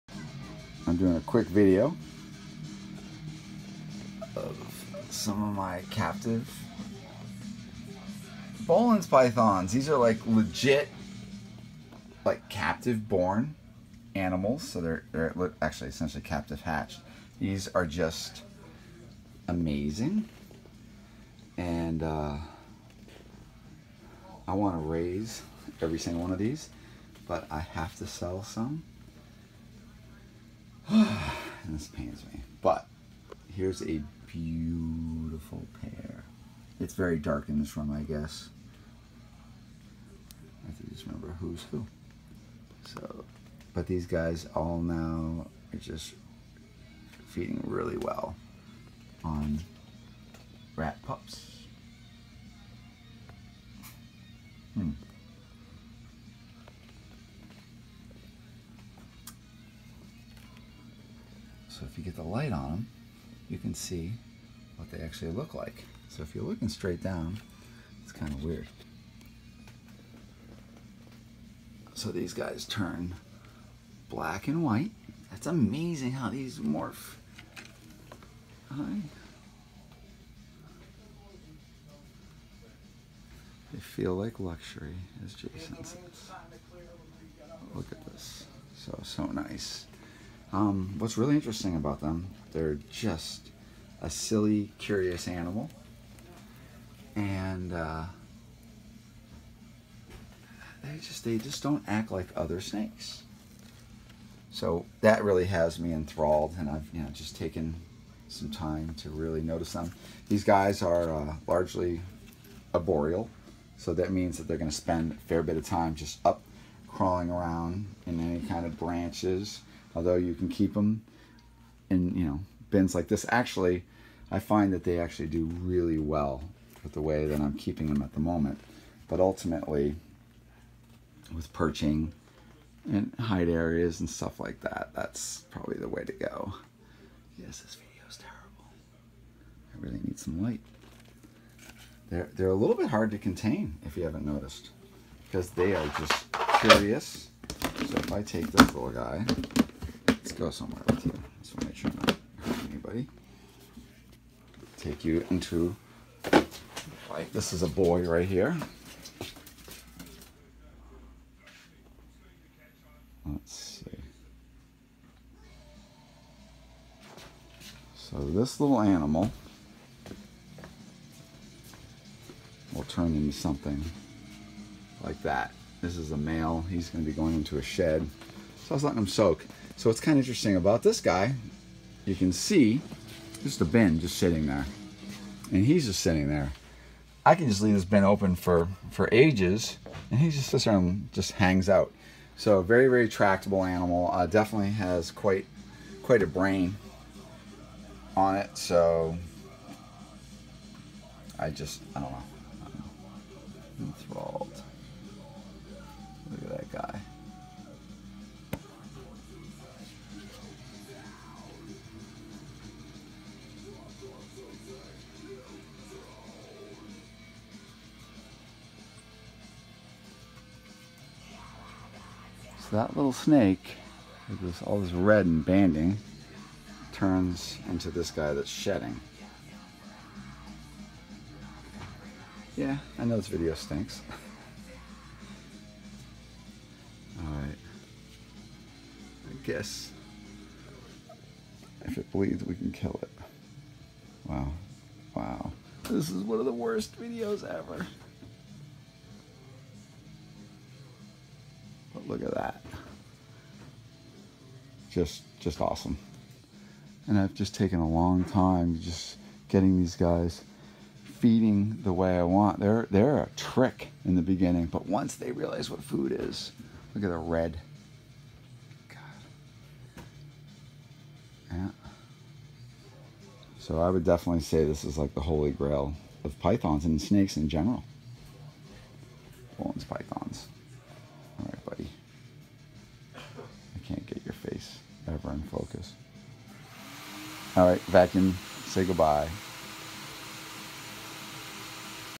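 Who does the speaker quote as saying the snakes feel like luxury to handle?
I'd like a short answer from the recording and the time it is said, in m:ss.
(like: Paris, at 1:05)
Jason, at 1:25.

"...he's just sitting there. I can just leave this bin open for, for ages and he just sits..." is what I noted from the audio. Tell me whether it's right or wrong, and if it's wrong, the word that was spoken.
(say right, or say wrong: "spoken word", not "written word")
right.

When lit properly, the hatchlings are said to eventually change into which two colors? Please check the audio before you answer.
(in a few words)
black and white.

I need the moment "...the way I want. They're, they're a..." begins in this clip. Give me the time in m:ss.
4:21.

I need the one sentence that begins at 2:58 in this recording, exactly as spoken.
So I was letting him soak.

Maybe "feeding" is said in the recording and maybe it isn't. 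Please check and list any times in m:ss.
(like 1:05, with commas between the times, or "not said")
0:47, 4:21.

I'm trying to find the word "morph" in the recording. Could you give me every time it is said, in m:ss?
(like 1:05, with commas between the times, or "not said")
1:16.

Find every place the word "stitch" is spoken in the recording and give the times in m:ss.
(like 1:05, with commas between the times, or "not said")
not said.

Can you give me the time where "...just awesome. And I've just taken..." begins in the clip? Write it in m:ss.
4:15.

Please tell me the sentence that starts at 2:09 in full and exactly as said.
But ultimately, with perching and hide areas and stuff like that, that's probably the way to go.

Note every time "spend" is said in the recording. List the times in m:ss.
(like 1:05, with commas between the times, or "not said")
1:54.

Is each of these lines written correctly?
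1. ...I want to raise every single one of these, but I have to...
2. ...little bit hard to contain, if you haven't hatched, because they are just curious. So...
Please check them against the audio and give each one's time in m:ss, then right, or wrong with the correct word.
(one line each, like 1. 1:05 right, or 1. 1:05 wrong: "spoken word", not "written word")
1. 0:24 right
2. 2:22 wrong: "noticed", not "hatched".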